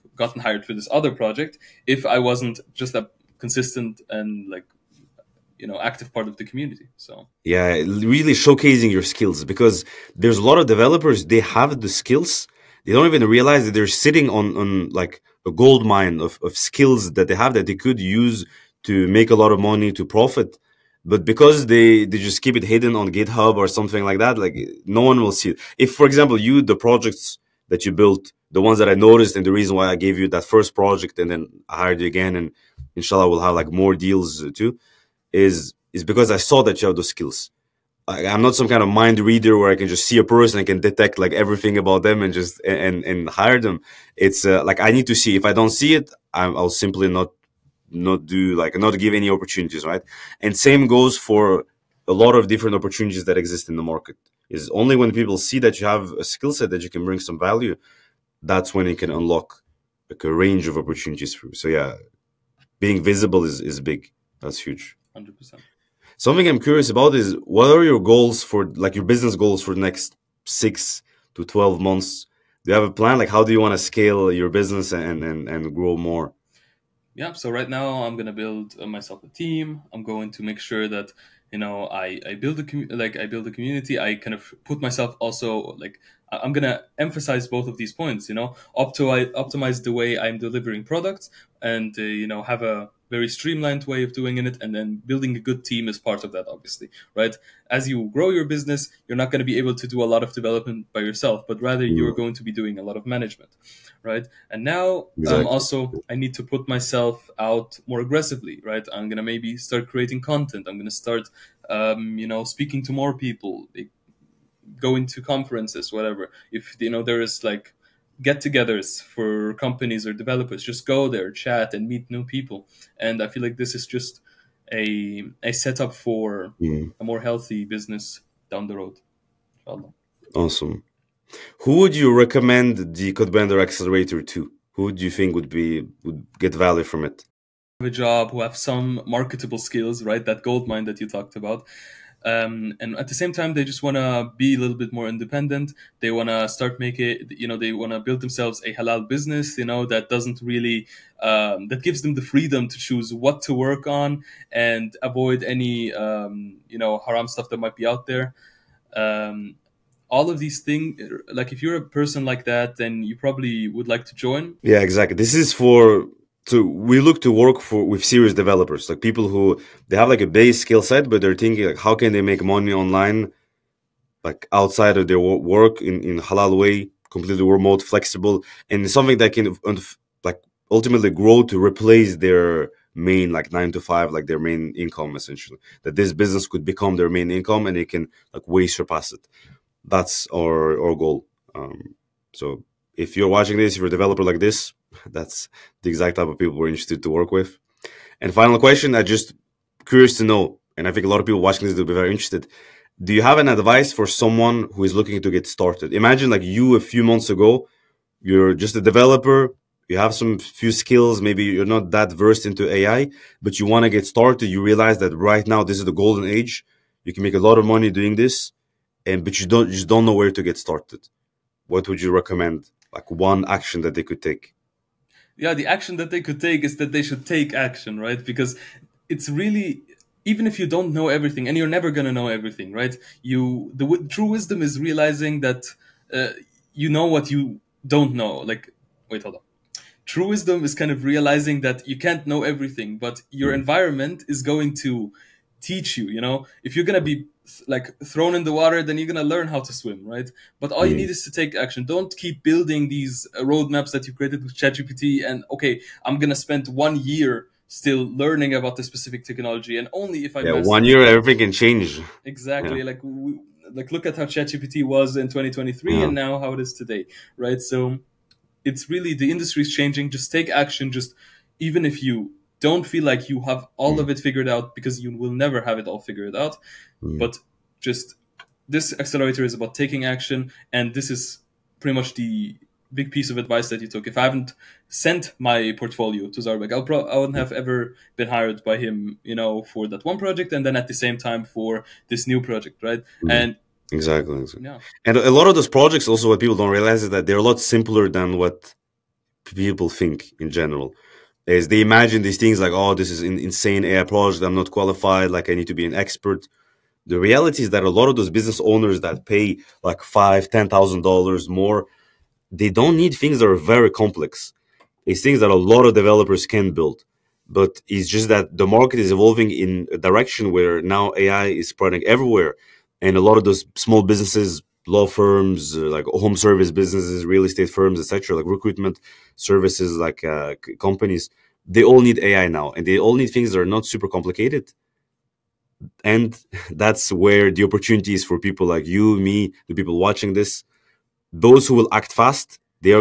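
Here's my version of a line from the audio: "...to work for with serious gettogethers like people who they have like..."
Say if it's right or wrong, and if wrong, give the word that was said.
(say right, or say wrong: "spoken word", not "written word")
wrong: "developers", not "gettogethers".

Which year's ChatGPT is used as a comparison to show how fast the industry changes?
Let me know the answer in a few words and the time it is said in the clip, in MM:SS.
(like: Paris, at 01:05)
2023, at 04:25.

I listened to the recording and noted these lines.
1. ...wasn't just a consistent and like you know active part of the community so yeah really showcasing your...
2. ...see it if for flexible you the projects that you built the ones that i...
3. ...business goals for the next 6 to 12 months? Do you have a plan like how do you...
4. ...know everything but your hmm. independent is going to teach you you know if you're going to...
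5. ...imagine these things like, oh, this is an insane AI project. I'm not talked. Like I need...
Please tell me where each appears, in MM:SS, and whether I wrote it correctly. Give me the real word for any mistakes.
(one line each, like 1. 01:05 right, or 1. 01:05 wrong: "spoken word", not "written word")
1. 00:02 right
2. 00:25 wrong: "example", not "flexible"
3. 01:09 right
4. 04:02 wrong: "environment", not "independent"
5. 05:01 wrong: "qualified", not "talked".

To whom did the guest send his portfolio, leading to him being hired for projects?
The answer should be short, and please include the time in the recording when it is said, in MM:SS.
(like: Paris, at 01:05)
Zaurbek, at 04:46.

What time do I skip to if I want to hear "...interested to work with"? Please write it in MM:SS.
03:16.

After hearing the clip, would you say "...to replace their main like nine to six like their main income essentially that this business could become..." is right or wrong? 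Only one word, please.
wrong.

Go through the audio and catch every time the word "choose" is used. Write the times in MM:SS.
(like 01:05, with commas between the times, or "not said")
02:32.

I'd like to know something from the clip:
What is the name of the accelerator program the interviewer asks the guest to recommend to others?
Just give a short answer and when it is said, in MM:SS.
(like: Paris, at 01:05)
Codebender Accelerator, at 02:13.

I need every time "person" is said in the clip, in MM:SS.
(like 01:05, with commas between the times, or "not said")
00:40, 02:41.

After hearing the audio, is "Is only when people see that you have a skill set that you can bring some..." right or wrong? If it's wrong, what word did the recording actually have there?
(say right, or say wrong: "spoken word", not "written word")
right.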